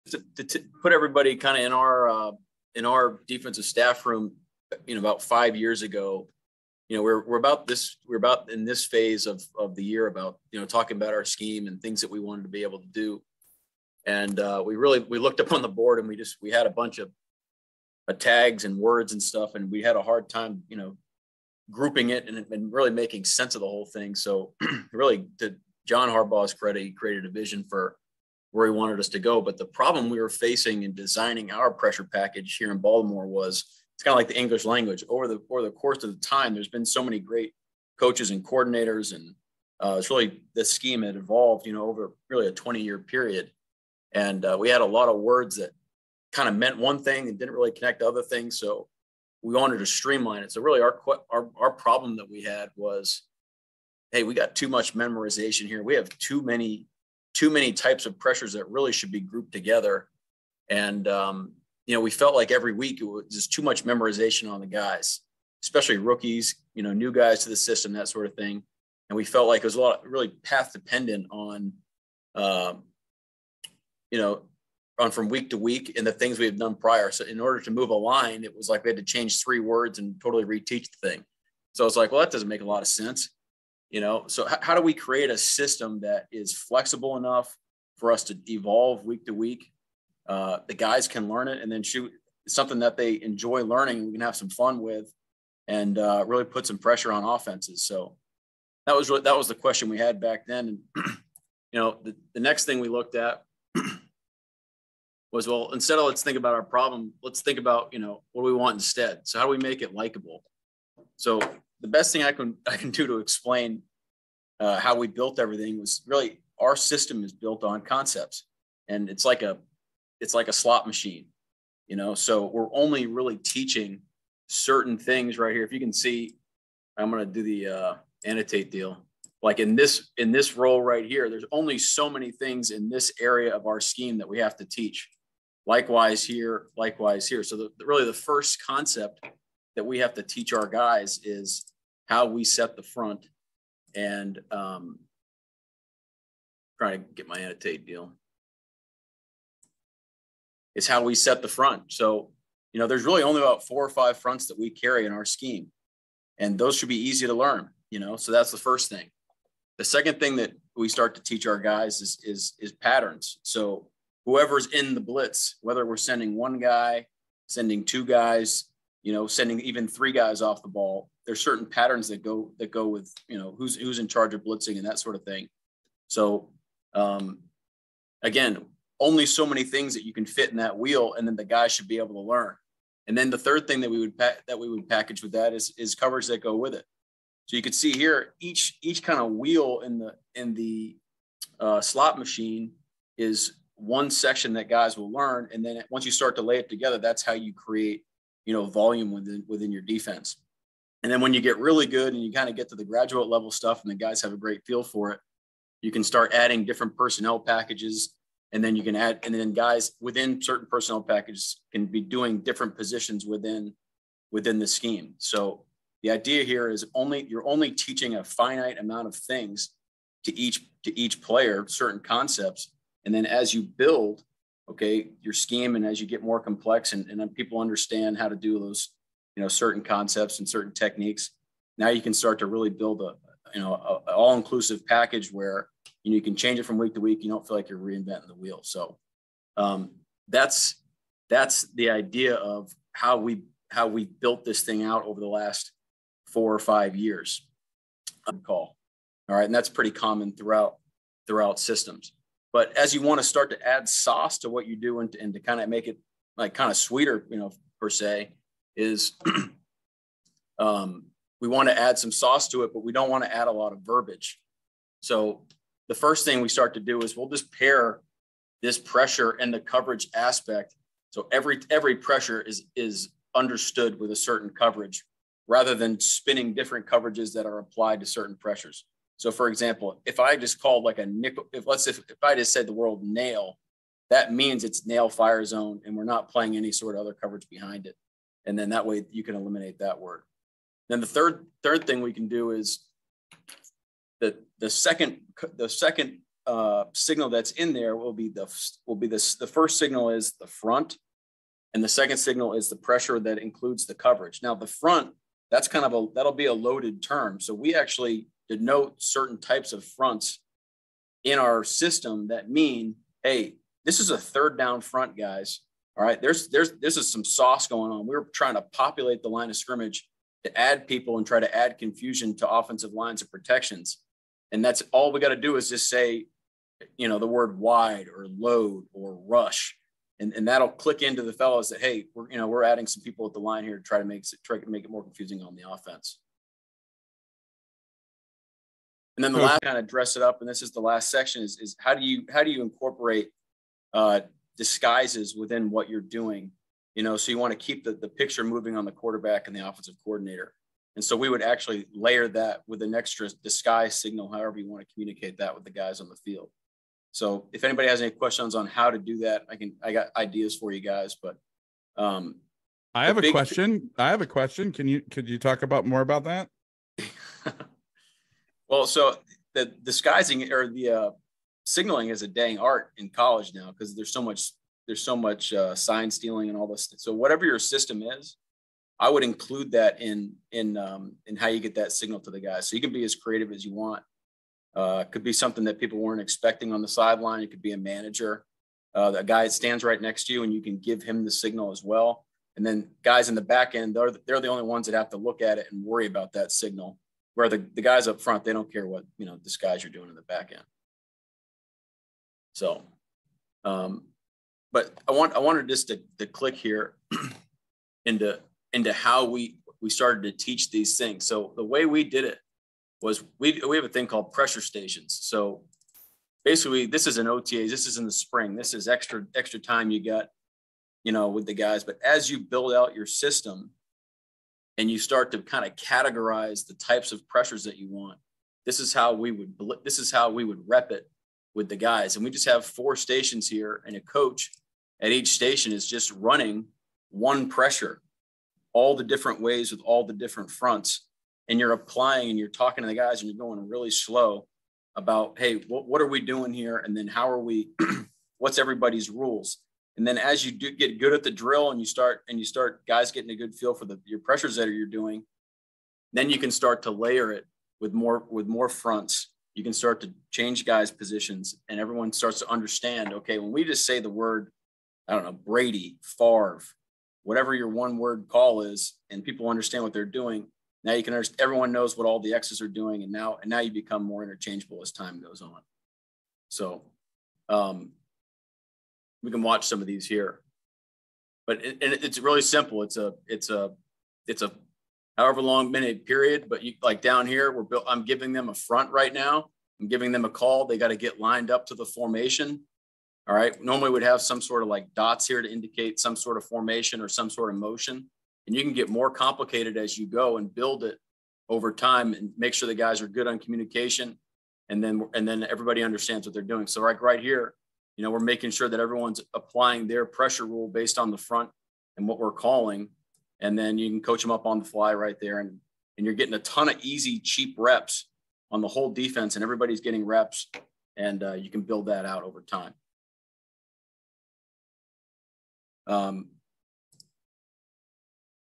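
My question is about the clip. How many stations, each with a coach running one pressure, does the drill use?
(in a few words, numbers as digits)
4.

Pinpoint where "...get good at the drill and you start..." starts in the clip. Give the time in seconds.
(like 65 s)
450 s.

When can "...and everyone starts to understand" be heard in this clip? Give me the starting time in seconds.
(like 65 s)
461 s.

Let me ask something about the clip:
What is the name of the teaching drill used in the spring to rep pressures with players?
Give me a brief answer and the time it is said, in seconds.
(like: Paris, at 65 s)
Pressure stations, at 414 s.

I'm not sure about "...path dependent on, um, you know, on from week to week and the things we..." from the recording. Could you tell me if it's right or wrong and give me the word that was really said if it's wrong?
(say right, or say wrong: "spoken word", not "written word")
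right.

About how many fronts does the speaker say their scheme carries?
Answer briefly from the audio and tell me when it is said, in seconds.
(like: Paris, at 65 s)
4 or 5, at 153 s.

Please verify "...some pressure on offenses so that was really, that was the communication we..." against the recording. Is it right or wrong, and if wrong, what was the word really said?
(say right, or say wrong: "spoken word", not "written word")
wrong: "question", not "communication".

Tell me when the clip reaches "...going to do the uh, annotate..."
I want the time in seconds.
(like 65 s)
127 s.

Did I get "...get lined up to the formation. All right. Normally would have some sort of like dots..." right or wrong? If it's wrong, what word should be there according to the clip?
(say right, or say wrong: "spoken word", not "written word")
right.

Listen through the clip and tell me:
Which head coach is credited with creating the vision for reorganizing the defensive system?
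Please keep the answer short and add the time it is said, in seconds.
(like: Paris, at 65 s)
John Harbaugh, at 25 s.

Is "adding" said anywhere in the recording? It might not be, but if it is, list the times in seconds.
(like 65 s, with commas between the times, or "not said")
206 s, 332 s.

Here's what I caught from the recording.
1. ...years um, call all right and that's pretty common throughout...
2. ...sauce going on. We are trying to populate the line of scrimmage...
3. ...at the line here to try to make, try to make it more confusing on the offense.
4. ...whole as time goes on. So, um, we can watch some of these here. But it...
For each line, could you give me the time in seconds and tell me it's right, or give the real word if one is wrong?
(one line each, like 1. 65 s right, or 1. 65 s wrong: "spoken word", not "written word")
1. 246 s right
2. 317 s right
3. 333 s right
4. 474 s wrong: "interchangeable", not "whole".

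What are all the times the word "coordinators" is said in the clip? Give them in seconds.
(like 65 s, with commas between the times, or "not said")
38 s, 350 s.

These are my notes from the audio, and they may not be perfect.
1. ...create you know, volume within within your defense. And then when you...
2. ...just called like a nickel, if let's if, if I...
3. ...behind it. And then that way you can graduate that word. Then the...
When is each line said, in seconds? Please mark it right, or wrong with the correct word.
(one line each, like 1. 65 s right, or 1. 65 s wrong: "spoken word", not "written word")
1. 197 s right
2. 280 s right
3. 287 s wrong: "eliminate", not "graduate".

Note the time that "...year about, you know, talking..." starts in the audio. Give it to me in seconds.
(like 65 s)
9 s.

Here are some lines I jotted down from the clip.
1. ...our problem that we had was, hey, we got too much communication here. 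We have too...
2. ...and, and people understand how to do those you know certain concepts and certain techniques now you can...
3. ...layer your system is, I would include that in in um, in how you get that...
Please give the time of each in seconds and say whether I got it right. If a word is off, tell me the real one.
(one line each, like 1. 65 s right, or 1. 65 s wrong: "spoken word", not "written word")
1. 51 s wrong: "memorization", not "communication"
2. 226 s right
3. 377 s wrong: "whatever", not "layer".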